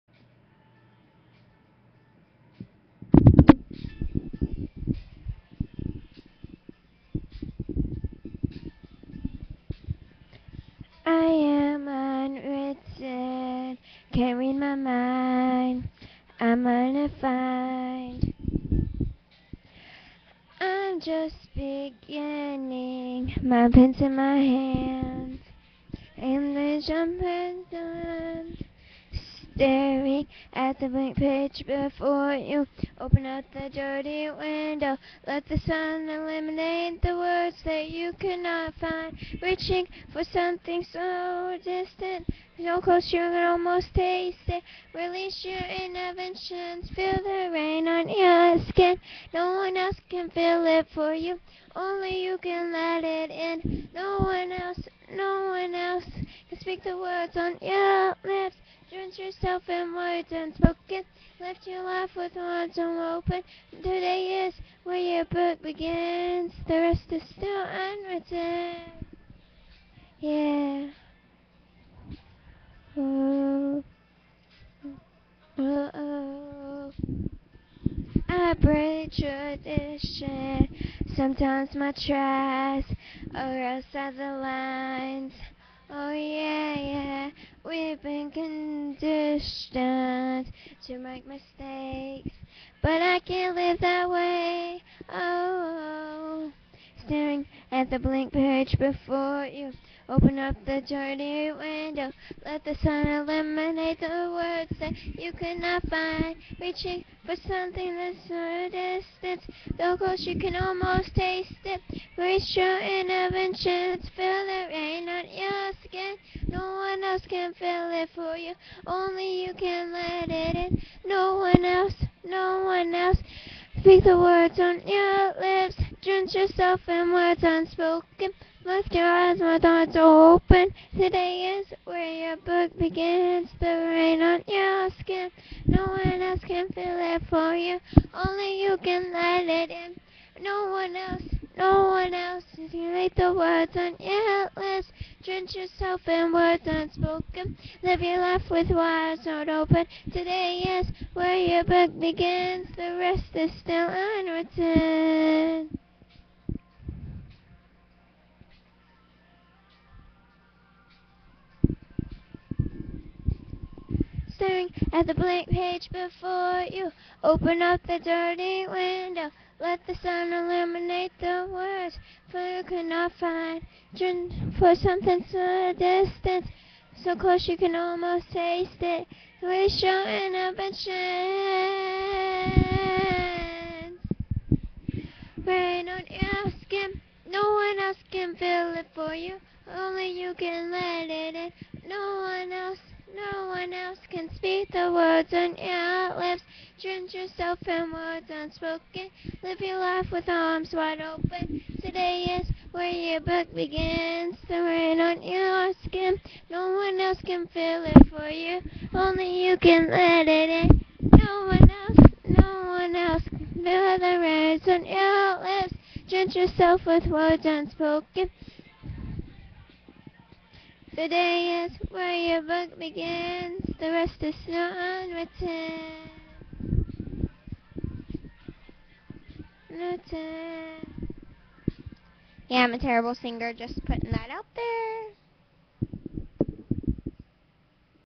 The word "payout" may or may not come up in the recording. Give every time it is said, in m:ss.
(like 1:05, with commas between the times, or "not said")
not said.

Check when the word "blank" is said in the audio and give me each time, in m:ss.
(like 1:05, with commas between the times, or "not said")
0:30, 1:37, 2:45.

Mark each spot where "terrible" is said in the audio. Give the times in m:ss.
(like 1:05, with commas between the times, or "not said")
3:52.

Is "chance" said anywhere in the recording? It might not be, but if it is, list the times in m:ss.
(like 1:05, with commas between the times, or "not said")
3:00.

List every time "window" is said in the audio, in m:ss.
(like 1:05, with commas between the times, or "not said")
0:34, 1:41, 2:48.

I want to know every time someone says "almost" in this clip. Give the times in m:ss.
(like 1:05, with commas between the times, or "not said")
0:43, 1:50, 2:57.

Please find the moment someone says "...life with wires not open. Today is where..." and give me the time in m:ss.
2:28.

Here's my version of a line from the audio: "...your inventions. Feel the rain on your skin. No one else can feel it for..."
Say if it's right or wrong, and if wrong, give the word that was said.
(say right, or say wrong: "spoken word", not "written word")
right.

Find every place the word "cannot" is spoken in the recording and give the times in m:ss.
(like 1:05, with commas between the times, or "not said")
0:38, 1:45, 2:52.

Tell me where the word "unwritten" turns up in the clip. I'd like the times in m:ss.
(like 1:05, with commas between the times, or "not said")
1:07, 2:33, 3:44.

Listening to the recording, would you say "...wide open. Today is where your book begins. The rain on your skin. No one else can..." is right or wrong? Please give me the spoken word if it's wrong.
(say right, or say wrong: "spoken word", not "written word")
right.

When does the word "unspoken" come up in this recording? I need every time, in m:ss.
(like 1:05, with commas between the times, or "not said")
1:00, 2:07, 2:26, 3:18, 3:37.